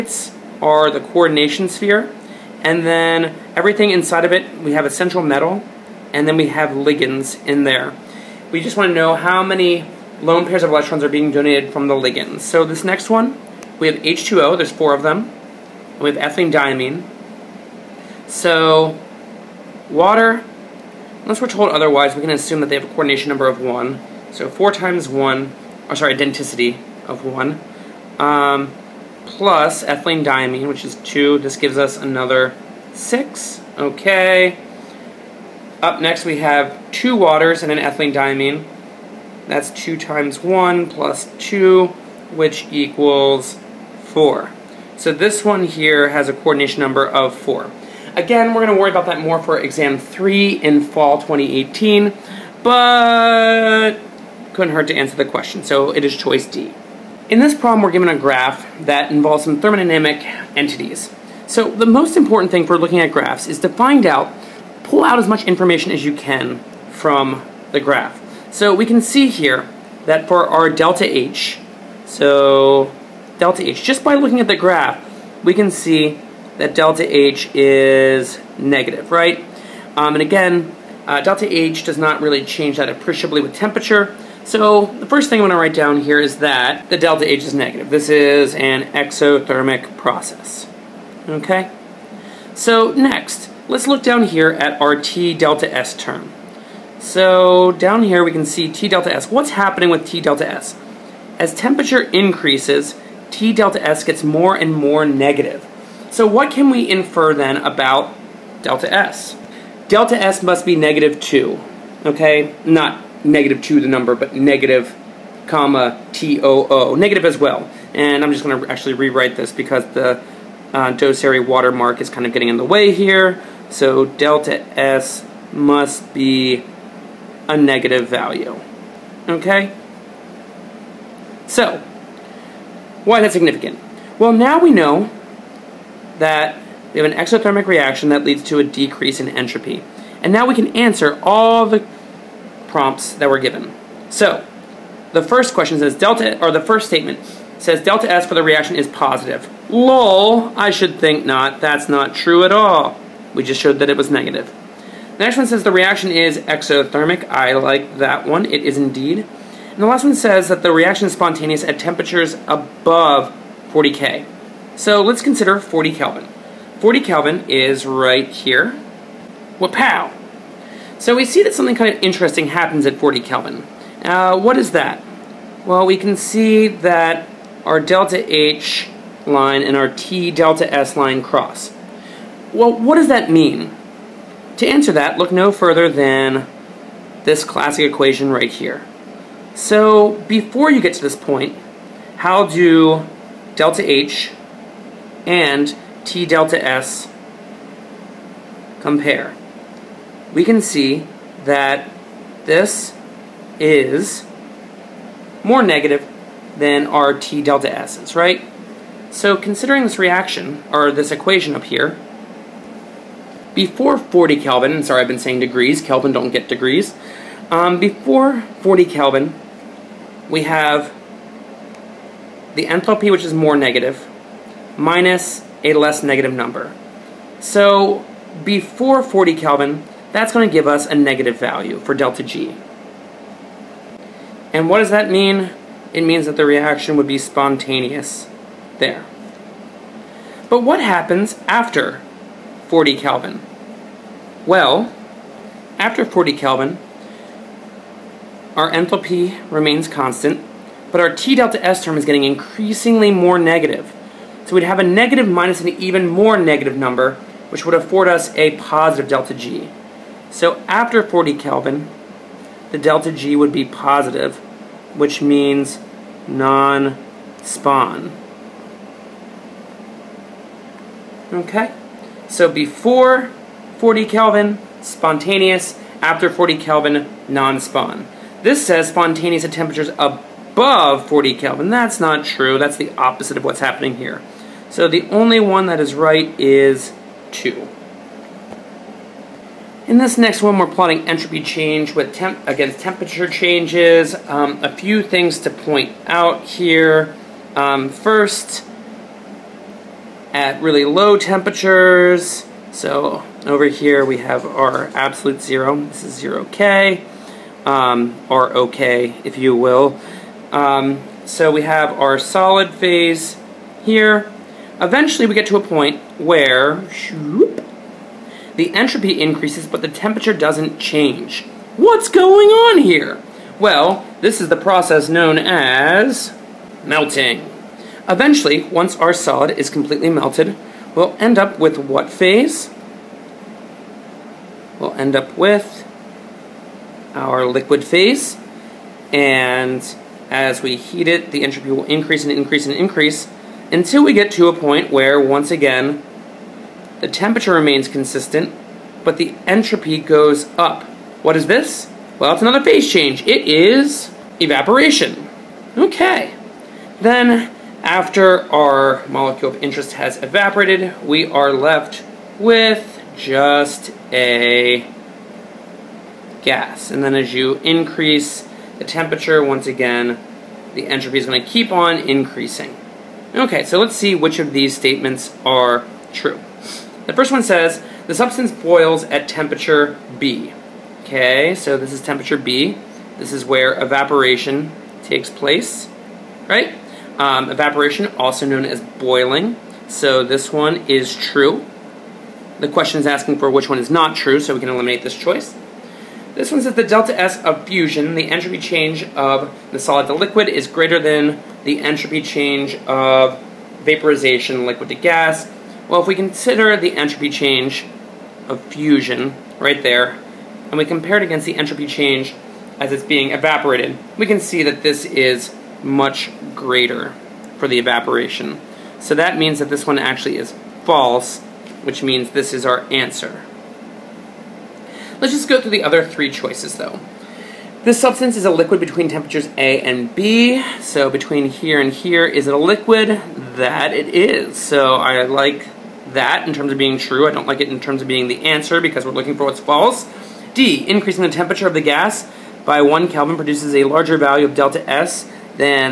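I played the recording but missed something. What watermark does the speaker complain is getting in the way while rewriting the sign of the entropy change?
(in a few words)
Doceri.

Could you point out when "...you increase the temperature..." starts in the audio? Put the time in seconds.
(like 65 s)
367 s.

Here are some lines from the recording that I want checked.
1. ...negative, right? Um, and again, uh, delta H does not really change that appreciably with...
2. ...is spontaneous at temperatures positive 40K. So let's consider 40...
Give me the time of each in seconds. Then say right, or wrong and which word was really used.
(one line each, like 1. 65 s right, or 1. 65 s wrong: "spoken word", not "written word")
1. 78 s right
2. 161 s wrong: "above", not "positive".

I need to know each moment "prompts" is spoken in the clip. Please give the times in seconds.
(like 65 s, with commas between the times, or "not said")
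142 s.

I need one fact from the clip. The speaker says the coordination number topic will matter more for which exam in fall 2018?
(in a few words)
Exam 3.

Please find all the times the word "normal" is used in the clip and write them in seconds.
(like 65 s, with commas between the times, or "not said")
not said.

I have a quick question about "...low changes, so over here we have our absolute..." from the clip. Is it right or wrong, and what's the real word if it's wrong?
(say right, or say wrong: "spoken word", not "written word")
wrong: "temperatures", not "changes".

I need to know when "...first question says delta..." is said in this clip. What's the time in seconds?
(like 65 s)
145 s.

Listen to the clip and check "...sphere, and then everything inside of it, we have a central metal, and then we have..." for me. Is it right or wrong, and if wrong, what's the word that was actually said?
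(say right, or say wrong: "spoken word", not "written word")
right.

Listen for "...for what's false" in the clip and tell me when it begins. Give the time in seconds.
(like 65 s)
439 s.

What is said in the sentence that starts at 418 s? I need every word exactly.
So that means that this one actually is false, which means this is our answer.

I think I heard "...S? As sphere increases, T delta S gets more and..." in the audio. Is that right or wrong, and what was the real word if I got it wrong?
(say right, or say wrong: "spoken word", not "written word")
wrong: "temperature", not "sphere".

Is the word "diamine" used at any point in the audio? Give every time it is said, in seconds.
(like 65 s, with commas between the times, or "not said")
16 s, 30 s, 38 s.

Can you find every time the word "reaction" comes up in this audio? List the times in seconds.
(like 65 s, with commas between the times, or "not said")
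137 s, 148 s, 155 s, 160 s, 209 s, 236 s.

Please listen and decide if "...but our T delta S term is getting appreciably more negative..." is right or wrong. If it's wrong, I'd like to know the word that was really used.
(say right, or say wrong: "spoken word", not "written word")
wrong: "increasingly", not "appreciably".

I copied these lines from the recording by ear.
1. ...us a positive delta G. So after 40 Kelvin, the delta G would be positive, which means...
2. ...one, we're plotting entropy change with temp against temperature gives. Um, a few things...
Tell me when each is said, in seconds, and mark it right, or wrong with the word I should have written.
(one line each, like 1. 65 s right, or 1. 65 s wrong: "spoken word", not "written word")
1. 258 s right
2. 290 s wrong: "changes", not "gives".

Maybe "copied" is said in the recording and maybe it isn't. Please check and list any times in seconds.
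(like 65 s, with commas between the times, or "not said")
not said.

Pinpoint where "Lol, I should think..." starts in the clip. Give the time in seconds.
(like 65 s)
149 s.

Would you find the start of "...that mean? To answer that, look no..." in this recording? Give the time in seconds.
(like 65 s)
183 s.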